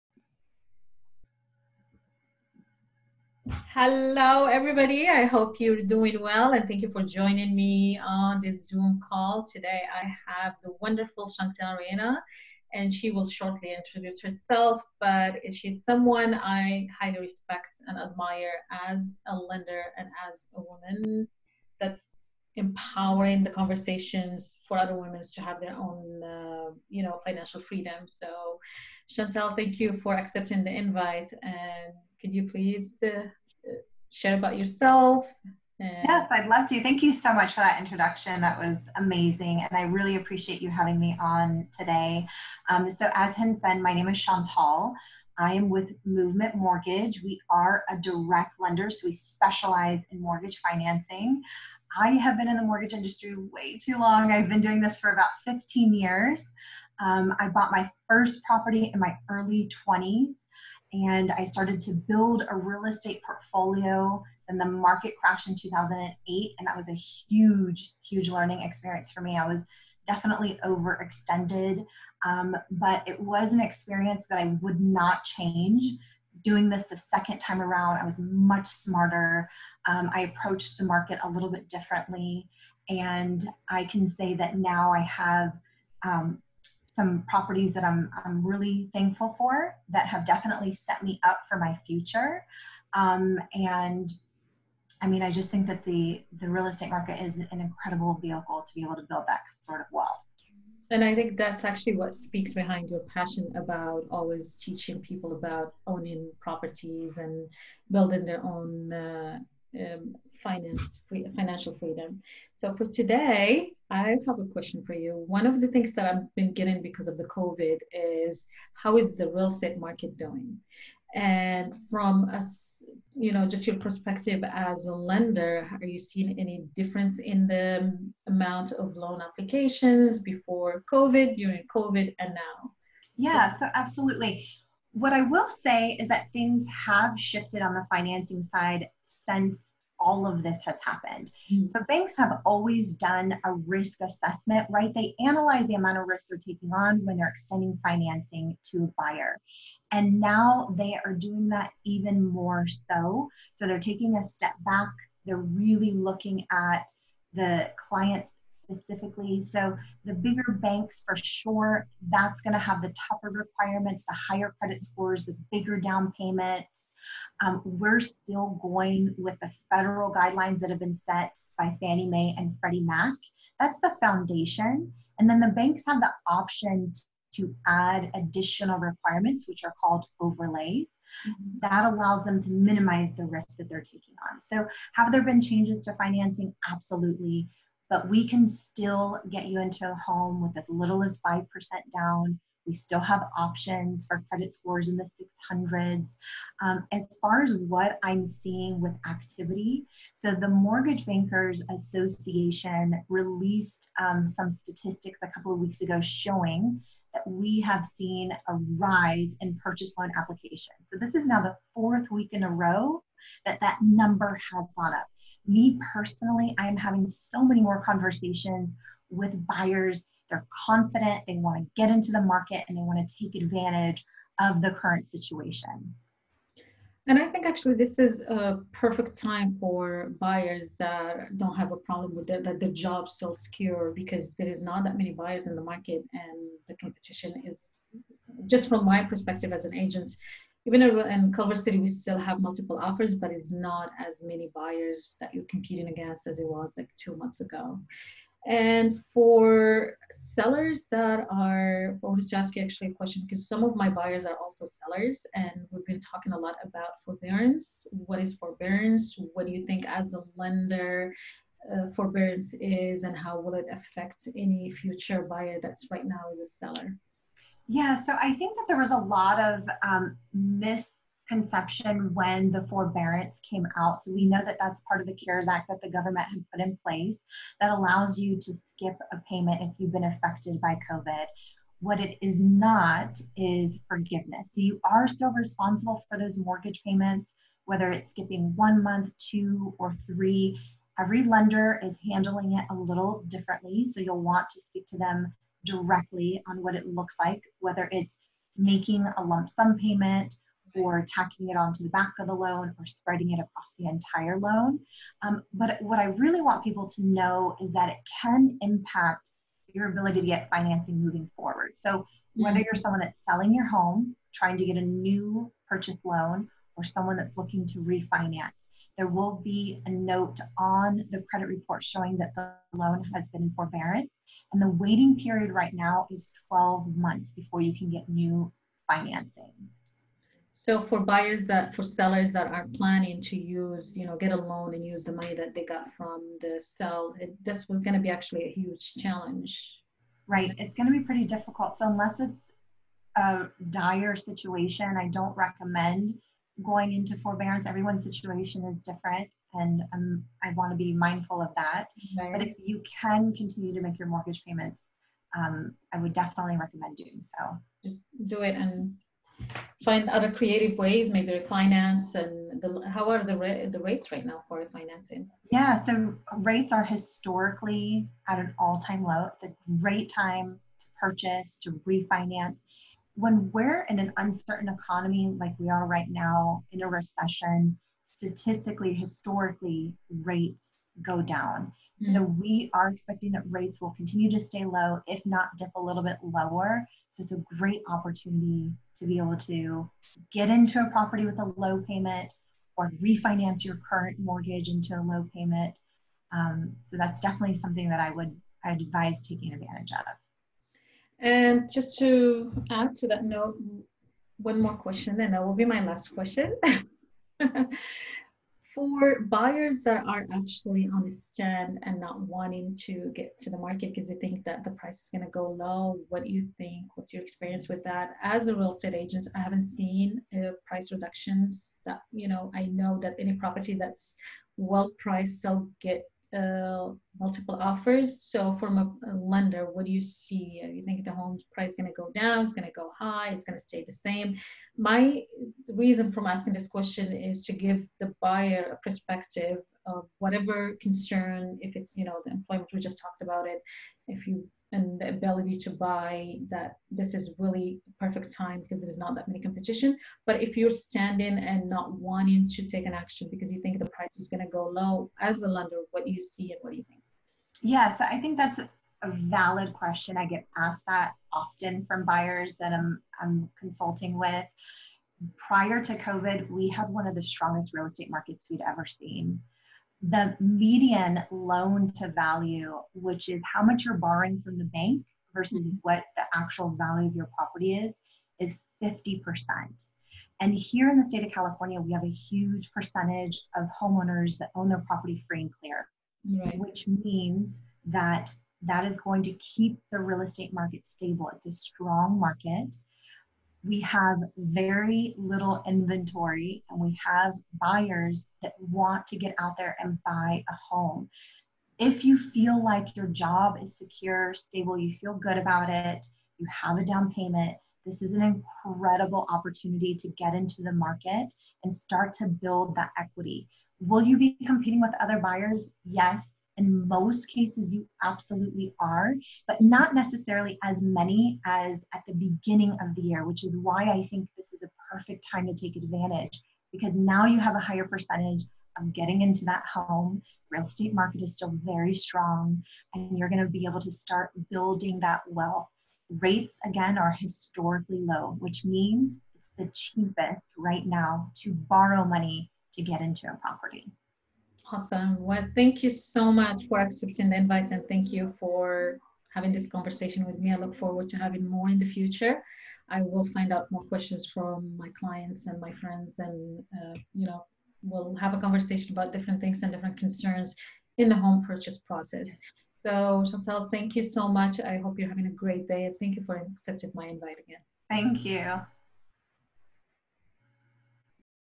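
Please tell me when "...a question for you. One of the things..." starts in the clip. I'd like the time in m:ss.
1:54.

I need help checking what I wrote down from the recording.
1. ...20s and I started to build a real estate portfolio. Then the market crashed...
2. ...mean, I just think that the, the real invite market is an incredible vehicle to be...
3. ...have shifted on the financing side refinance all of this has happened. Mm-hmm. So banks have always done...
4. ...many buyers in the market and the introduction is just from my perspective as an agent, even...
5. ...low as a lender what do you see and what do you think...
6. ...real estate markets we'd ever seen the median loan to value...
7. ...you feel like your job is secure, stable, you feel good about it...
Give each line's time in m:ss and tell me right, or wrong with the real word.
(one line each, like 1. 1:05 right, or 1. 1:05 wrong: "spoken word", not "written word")
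1. 0:59 right
2. 1:35 wrong: "estate", not "invite"
3. 2:16 wrong: "since", not "refinance"
4. 3:54 wrong: "competition", not "introduction"
5. 7:34 right
6. 7:47 right
7. 8:22 right.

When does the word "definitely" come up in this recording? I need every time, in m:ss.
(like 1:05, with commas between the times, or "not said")
1:10, 1:30, 5:56, 6:37.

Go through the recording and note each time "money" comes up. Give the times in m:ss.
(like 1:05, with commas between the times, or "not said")
5:35, 9:02.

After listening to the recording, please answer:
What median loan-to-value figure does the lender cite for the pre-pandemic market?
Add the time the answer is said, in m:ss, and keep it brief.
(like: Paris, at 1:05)
50%, at 7:58.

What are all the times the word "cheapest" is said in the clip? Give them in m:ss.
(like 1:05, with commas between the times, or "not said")
8:59.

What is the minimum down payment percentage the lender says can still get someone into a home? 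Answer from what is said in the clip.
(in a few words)
5%.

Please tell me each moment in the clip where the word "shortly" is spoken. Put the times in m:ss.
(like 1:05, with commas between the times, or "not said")
0:13.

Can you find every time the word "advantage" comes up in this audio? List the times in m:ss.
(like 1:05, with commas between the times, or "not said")
3:43, 6:39, 8:45.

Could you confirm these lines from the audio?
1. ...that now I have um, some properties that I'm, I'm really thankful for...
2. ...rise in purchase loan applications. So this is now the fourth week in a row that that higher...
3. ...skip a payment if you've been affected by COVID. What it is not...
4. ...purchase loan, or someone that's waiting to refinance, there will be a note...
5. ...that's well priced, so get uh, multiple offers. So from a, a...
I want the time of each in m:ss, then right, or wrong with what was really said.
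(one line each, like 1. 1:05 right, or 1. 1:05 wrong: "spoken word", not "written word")
1. 1:24 right
2. 3:28 wrong: "number", not "higher"
3. 4:38 right
4. 5:15 wrong: "looking", not "waiting"
5. 7:03 right.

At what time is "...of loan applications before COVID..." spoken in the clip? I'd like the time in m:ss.
2:08.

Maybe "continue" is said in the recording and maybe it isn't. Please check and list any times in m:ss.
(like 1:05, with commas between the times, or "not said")
5:53, 6:23.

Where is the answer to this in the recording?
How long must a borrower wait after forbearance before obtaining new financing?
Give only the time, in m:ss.
5:26.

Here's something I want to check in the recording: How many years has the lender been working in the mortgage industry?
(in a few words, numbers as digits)
15.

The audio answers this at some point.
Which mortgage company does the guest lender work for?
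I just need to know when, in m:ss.
0:46.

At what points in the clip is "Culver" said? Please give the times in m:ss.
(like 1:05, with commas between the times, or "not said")
4:01.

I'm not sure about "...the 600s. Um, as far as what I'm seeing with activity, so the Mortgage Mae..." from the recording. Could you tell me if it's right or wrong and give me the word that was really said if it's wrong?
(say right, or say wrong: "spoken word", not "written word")
wrong: "Bankers", not "Mae".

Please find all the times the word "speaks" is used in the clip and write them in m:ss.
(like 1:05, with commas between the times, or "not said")
1:42, 4:54.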